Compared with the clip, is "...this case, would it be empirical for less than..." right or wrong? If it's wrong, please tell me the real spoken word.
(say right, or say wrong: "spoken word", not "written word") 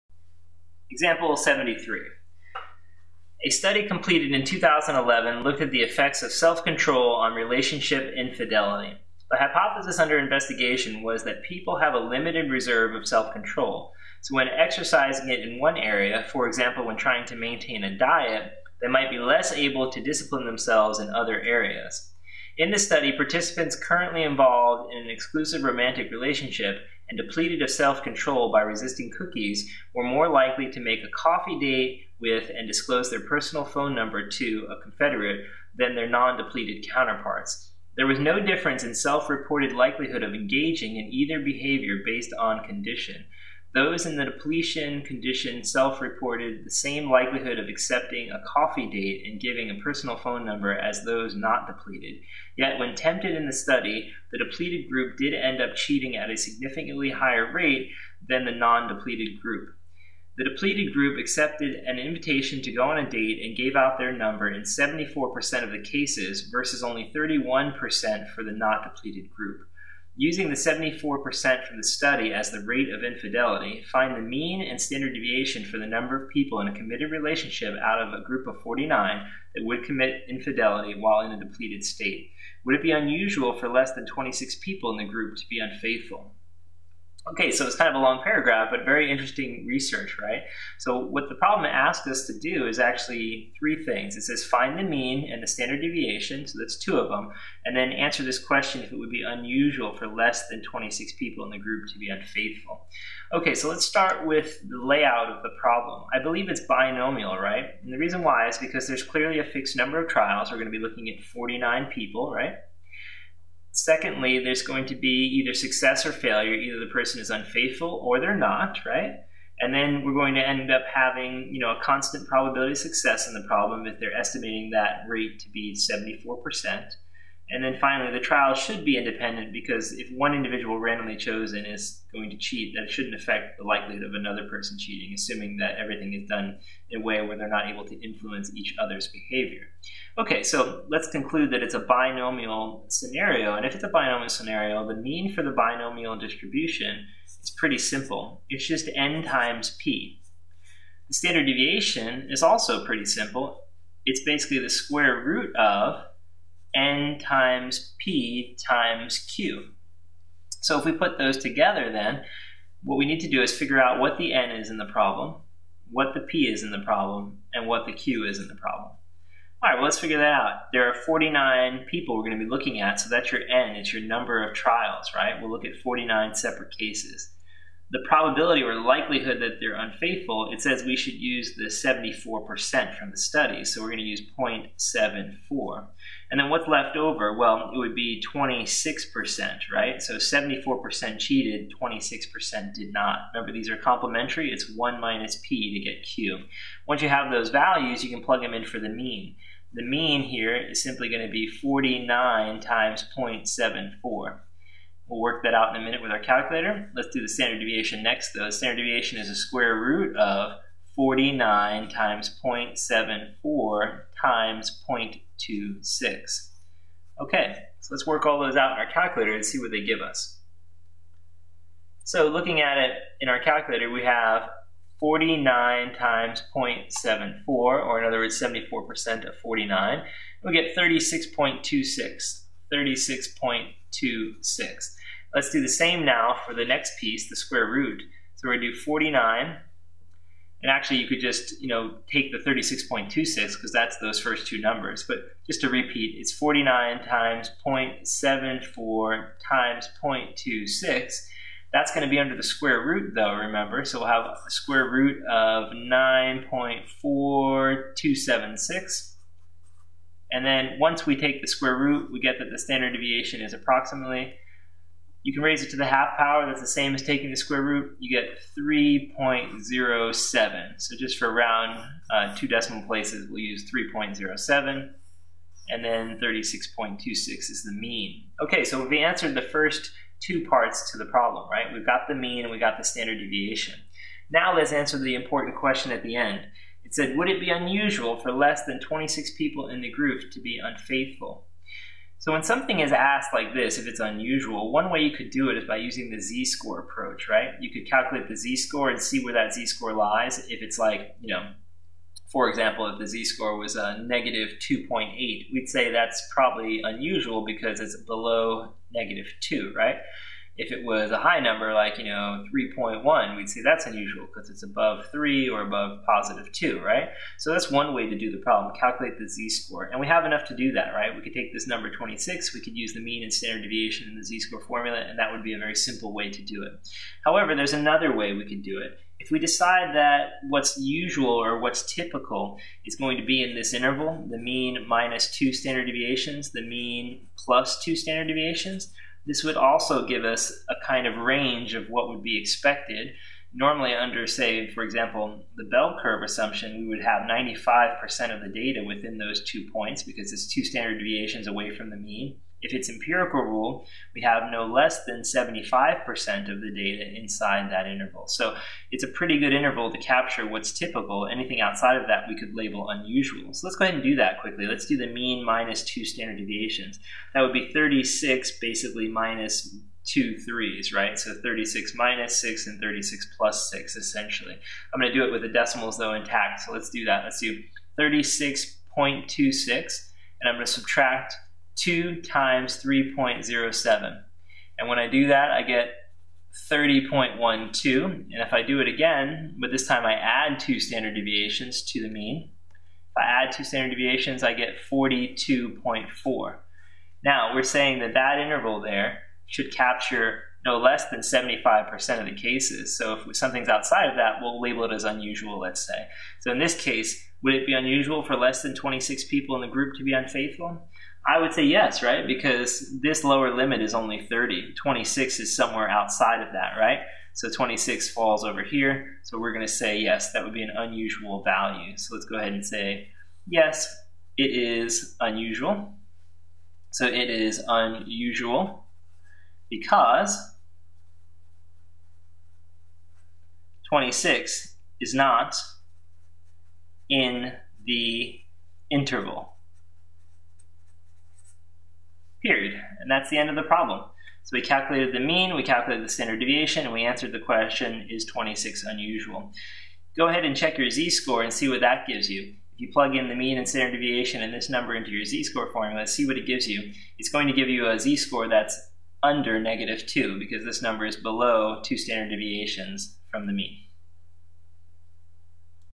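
wrong: "unusual", not "empirical".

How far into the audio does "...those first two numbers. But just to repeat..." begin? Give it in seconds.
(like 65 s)
243 s.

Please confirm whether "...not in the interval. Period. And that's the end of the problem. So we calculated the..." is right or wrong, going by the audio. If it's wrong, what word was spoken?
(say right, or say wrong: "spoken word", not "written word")
right.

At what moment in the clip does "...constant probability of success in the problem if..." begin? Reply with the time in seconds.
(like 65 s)
121 s.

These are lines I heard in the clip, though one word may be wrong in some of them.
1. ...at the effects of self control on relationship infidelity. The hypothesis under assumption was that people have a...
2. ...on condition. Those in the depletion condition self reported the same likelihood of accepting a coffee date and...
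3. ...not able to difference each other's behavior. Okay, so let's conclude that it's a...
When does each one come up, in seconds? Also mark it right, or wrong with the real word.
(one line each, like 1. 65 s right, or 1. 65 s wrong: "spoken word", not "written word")
1. 5 s wrong: "investigation", not "assumption"
2. 42 s right
3. 137 s wrong: "influence", not "difference".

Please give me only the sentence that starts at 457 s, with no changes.
It's going to give you a z-score that's under negative 2 because this number is below two standard deviations from the mean.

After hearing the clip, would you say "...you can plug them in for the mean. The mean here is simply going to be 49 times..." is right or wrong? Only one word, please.
right.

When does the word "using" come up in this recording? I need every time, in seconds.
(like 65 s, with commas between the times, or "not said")
70 s, 295 s.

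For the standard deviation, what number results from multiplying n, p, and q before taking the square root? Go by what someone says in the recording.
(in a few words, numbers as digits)
9.4276.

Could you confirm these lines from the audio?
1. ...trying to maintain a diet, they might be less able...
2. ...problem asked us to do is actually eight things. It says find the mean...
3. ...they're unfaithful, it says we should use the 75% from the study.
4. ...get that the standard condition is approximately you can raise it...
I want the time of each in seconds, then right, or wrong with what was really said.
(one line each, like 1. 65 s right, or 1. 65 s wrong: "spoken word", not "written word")
1. 16 s right
2. 91 s wrong: "three", not "eight"
3. 179 s wrong: "74", not "75"
4. 262 s wrong: "deviation", not "condition".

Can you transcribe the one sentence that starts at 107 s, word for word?
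And the reason why is because there's clearly a fixed number of trials.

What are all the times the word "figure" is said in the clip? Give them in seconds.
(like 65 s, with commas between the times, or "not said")
163 s, 169 s.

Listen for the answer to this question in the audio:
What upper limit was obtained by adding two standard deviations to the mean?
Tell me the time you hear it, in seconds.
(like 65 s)
394 s.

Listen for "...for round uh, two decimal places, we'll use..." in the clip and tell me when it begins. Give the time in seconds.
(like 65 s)
271 s.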